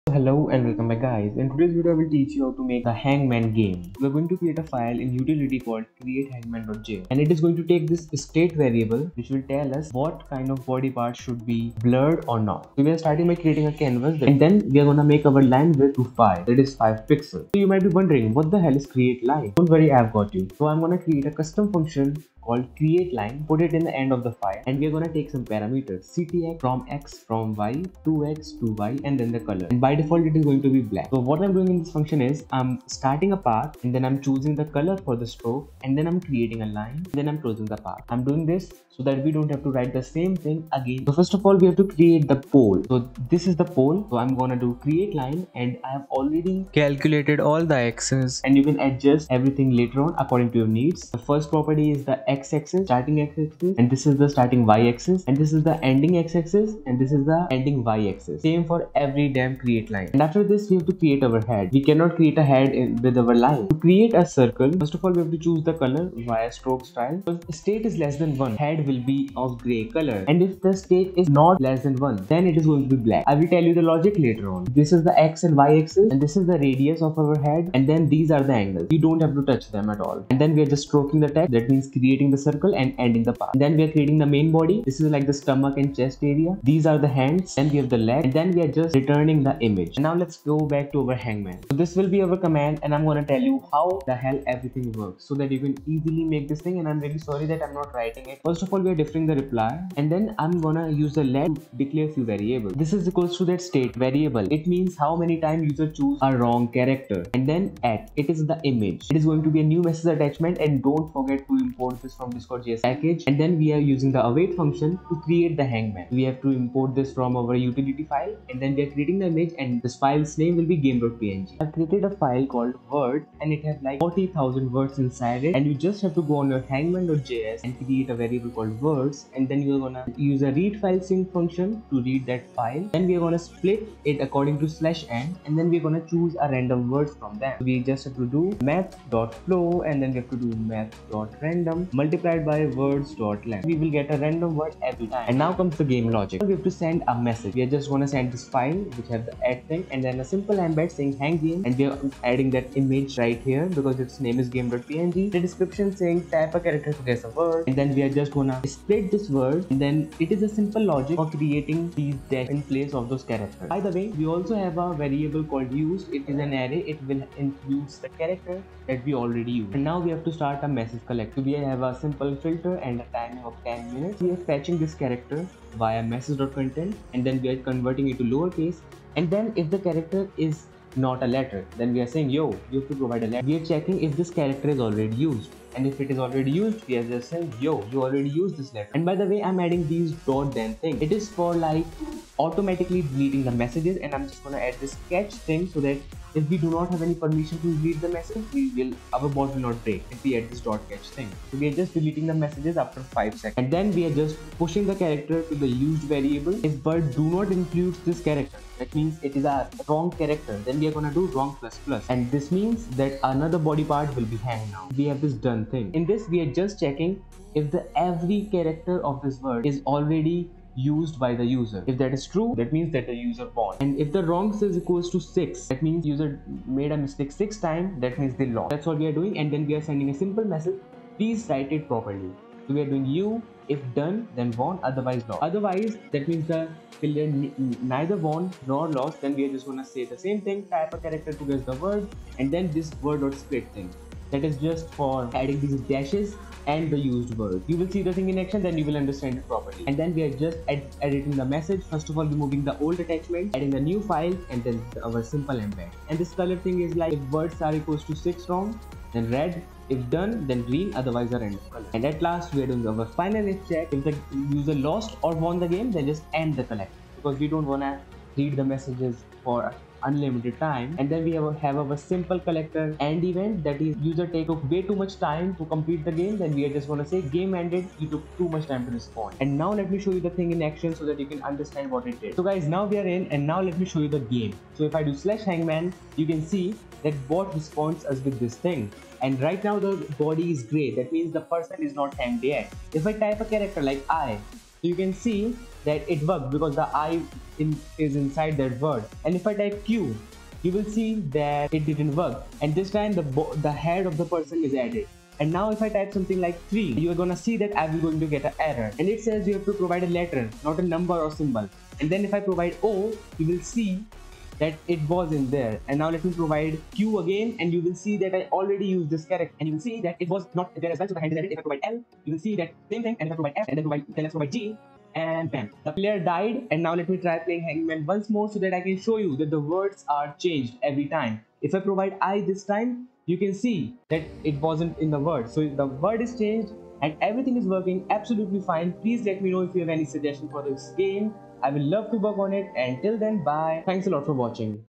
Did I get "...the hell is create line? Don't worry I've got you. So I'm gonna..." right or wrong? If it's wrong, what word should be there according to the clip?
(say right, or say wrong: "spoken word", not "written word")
right.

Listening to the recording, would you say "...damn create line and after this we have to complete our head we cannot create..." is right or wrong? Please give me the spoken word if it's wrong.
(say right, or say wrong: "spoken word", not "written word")
wrong: "create", not "complete".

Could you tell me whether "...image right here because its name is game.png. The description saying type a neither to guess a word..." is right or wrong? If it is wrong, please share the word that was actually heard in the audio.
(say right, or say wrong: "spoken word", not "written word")
wrong: "character", not "neither".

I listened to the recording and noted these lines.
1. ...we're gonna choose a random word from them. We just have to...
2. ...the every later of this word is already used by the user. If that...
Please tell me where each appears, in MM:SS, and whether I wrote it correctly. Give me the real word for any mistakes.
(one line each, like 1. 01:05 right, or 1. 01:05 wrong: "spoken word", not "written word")
1. 02:15 right
2. 03:37 wrong: "character", not "later".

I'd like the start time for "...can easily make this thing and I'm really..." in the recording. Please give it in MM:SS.
01:35.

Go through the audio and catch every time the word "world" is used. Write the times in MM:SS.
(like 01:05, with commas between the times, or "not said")
not said.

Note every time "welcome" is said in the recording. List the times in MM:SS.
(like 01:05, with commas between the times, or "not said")
00:00.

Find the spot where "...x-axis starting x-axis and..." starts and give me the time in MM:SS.
00:52.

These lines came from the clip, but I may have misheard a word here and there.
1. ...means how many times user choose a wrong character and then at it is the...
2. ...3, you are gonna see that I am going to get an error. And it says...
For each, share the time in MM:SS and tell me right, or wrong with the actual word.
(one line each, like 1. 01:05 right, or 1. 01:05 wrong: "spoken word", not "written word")
1. 01:44 right
2. 05:06 right.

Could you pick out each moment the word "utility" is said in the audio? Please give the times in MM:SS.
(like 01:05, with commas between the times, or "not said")
00:05, 01:57.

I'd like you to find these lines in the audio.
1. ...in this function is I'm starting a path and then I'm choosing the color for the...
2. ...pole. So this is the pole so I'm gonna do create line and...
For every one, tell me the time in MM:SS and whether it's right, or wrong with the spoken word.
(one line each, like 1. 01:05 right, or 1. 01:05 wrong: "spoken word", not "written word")
1. 00:31 right
2. 00:42 right.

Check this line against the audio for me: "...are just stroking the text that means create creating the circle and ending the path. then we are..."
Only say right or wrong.
right.